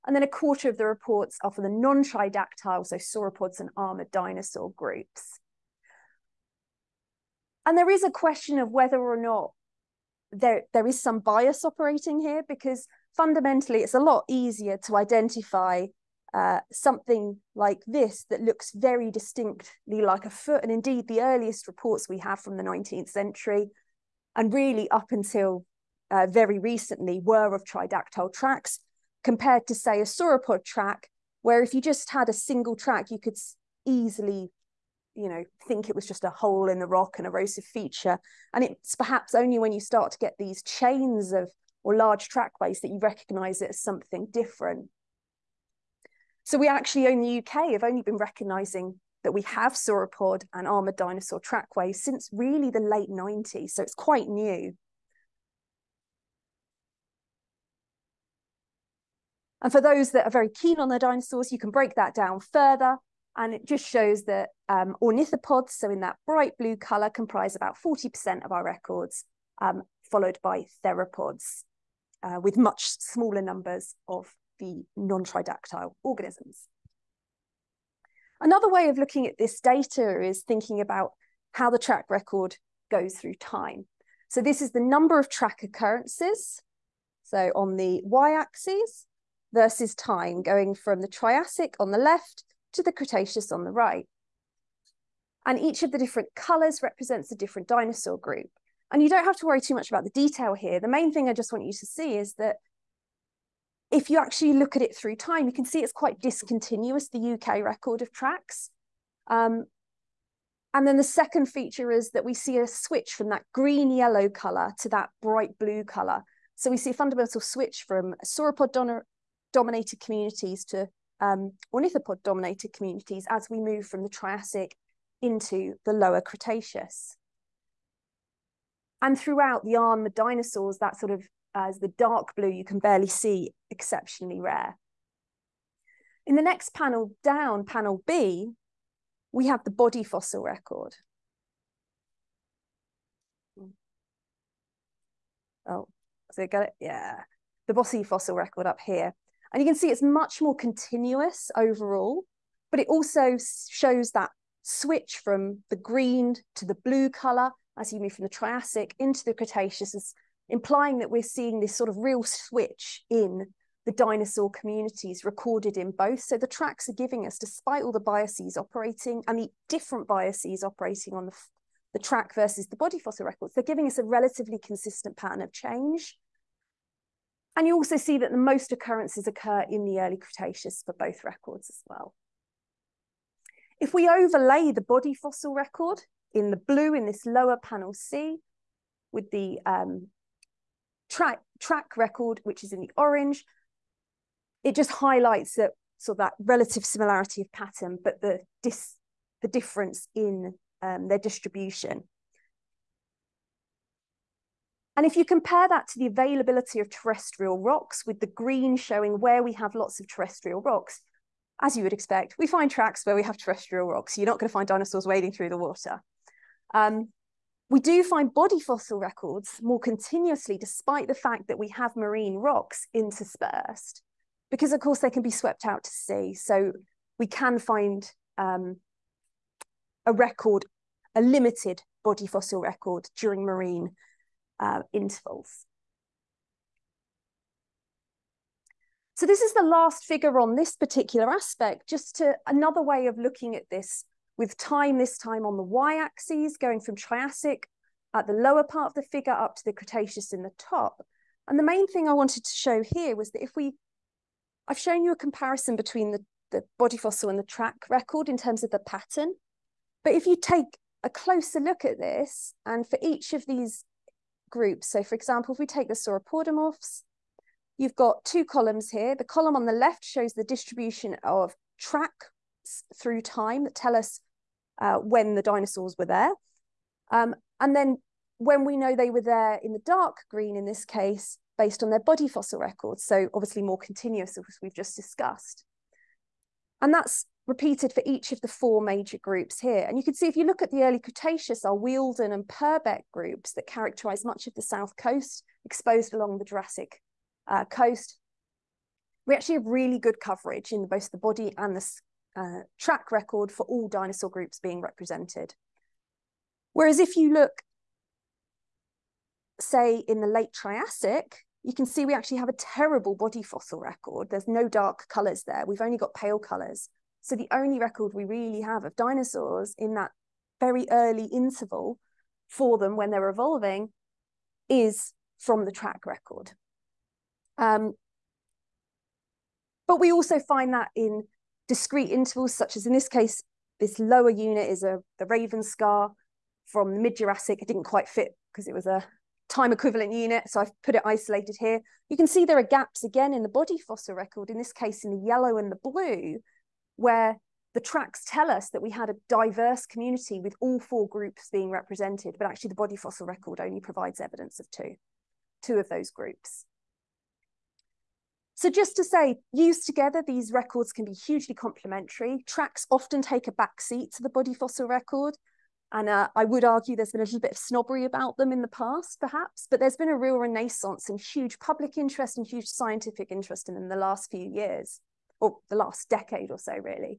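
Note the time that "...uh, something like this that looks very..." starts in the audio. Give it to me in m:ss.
0:16.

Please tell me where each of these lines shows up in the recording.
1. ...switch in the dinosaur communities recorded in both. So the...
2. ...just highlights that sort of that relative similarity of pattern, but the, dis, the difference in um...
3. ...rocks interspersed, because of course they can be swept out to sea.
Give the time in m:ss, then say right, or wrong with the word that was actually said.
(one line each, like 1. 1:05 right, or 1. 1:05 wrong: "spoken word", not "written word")
1. 2:42 right
2. 3:14 right
3. 3:42 right.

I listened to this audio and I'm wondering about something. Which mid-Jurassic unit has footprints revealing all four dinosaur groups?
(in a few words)
Ravenscar.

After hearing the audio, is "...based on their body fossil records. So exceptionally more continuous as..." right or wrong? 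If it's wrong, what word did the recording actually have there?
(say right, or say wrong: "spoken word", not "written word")
wrong: "obviously", not "exceptionally".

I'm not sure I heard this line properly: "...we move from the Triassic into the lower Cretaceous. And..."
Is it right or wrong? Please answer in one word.
right.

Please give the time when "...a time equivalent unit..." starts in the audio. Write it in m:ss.
5:38.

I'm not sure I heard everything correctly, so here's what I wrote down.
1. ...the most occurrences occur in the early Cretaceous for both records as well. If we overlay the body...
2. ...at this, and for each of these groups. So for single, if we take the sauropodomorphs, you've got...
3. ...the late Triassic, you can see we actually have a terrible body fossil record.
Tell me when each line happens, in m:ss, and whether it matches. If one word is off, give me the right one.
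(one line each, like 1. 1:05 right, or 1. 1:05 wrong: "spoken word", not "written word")
1. 2:58 right
2. 4:21 wrong: "example", not "single"
3. 5:10 right.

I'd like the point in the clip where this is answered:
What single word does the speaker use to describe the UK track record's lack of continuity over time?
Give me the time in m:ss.
1:46.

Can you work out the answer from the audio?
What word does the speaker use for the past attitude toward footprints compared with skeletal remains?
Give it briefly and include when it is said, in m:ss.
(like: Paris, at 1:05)
snobbery, at 6:07.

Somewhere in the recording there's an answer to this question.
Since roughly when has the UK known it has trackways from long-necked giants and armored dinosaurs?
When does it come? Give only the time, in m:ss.
0:52.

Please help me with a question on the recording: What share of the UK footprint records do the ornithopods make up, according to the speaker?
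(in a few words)
40%.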